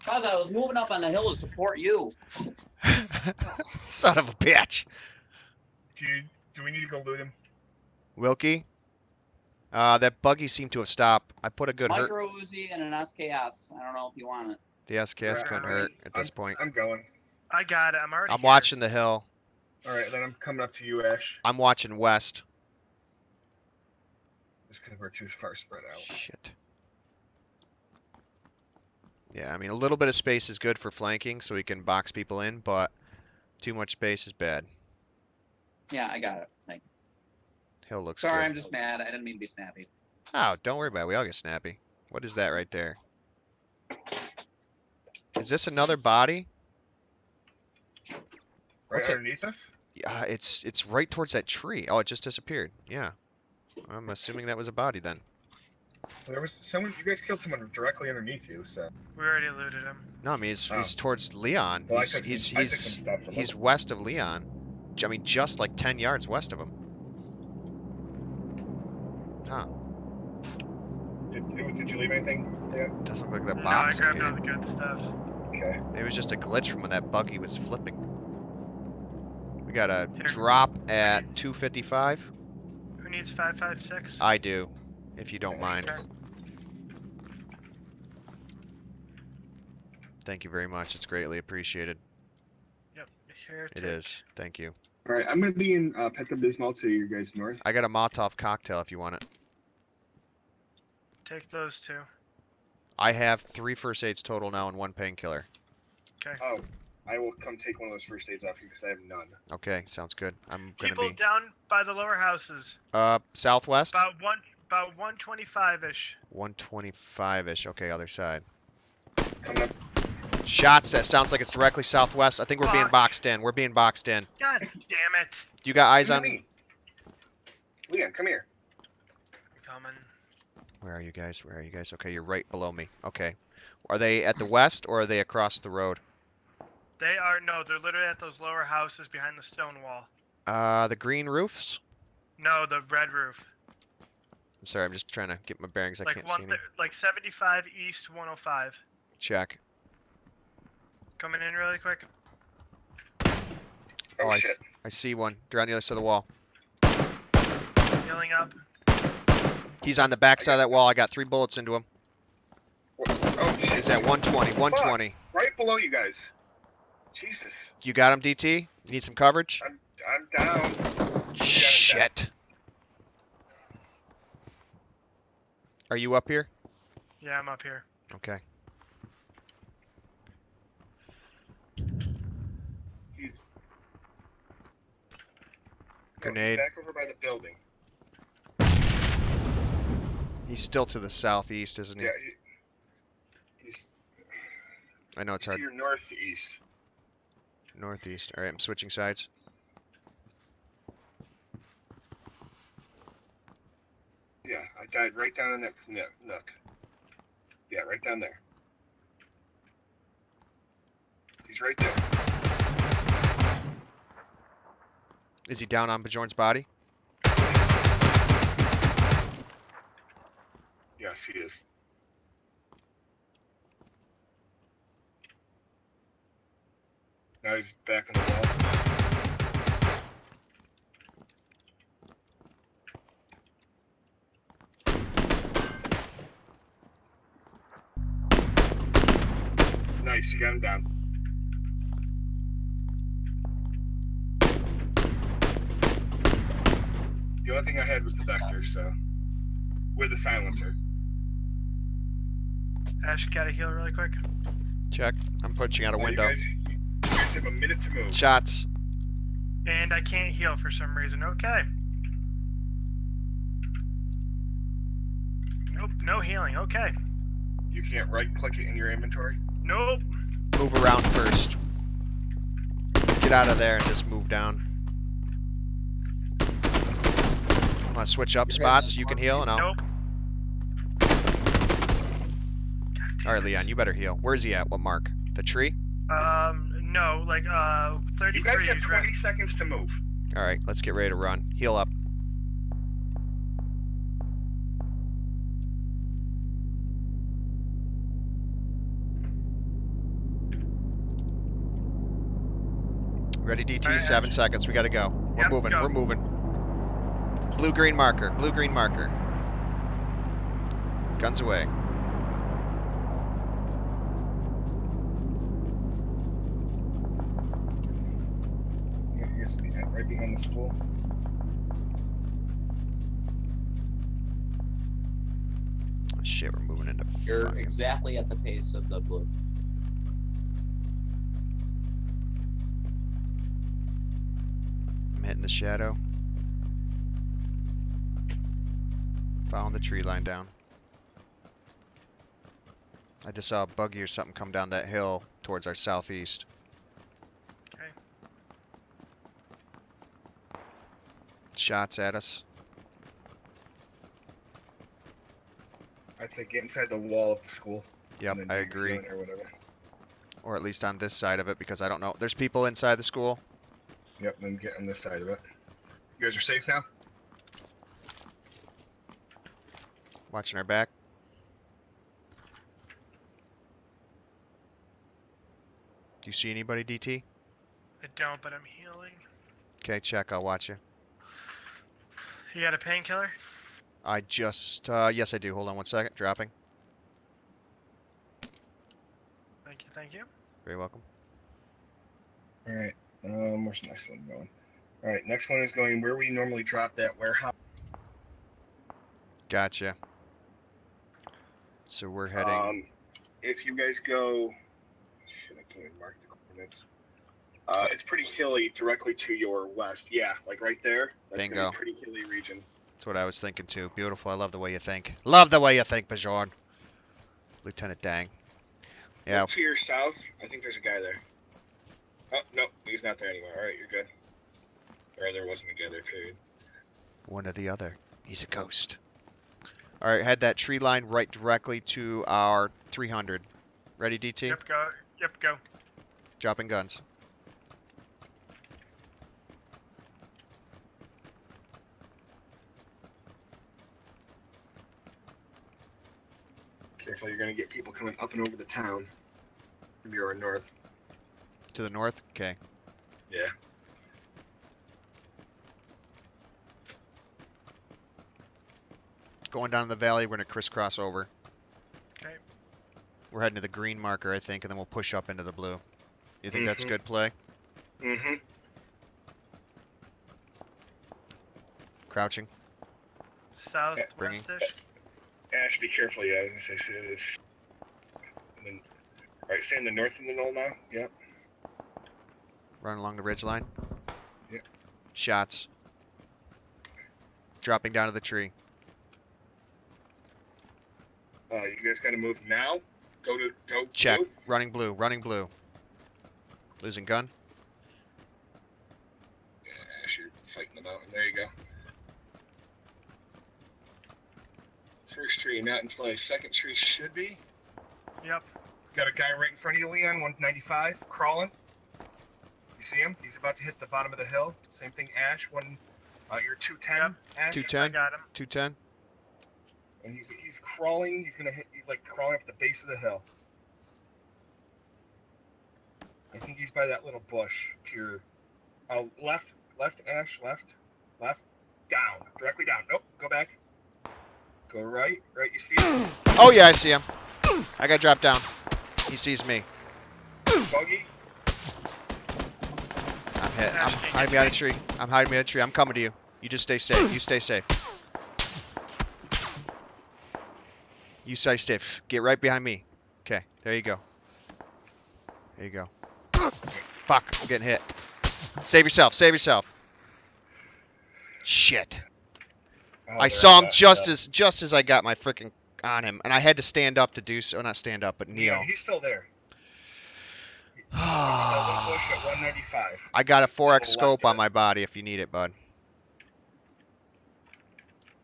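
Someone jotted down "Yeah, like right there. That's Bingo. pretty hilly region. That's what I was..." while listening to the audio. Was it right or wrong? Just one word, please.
right.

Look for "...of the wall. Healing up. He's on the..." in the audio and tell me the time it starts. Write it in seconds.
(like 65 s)
155 s.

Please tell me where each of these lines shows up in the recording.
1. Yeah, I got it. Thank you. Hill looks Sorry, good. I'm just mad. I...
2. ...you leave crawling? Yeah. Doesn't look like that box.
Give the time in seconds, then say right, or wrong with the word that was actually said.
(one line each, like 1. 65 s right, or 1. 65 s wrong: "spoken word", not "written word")
1. 35 s right
2. 71 s wrong: "anything", not "crawling".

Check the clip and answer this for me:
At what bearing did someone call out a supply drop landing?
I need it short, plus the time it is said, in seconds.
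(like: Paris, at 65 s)
255, at 80 s.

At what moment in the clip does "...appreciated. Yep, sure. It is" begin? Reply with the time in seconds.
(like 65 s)
91 s.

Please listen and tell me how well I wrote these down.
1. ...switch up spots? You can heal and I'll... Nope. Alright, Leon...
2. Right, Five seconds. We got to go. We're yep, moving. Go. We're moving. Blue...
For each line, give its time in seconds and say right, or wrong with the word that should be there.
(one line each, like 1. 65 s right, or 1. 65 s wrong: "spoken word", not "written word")
1. 278 s right
2. 303 s wrong: "Seven", not "Five".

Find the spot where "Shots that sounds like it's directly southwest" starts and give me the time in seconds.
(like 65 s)
120 s.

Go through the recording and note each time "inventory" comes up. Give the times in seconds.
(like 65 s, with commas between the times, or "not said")
268 s.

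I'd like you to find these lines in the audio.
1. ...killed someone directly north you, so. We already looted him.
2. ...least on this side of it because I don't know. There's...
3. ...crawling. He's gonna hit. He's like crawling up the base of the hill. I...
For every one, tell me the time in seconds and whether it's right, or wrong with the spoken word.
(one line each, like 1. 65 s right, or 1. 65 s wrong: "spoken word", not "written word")
1. 57 s wrong: "underneath", not "north"
2. 360 s right
3. 520 s right.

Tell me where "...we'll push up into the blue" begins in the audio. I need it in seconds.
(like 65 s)
464 s.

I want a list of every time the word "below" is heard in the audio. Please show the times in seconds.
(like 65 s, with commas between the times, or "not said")
132 s, 165 s.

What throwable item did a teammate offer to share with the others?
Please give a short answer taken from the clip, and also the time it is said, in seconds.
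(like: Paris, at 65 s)
Molotov cocktail, at 97 s.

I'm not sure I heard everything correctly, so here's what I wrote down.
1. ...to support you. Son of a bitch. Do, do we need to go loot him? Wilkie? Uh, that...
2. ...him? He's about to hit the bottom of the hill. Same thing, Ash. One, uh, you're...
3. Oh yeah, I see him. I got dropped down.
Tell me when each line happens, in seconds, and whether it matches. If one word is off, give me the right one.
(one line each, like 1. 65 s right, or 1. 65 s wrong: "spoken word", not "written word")
1. 1 s right
2. 512 s right
3. 536 s right.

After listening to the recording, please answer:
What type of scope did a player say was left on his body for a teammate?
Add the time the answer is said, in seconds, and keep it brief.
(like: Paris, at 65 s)
4x scope, at 573 s.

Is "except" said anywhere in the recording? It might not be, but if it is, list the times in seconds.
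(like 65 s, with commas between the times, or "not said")
not said.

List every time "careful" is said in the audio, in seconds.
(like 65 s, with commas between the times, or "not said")
446 s, 475 s.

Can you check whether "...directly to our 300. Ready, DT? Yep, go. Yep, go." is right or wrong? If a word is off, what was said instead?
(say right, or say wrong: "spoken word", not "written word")
right.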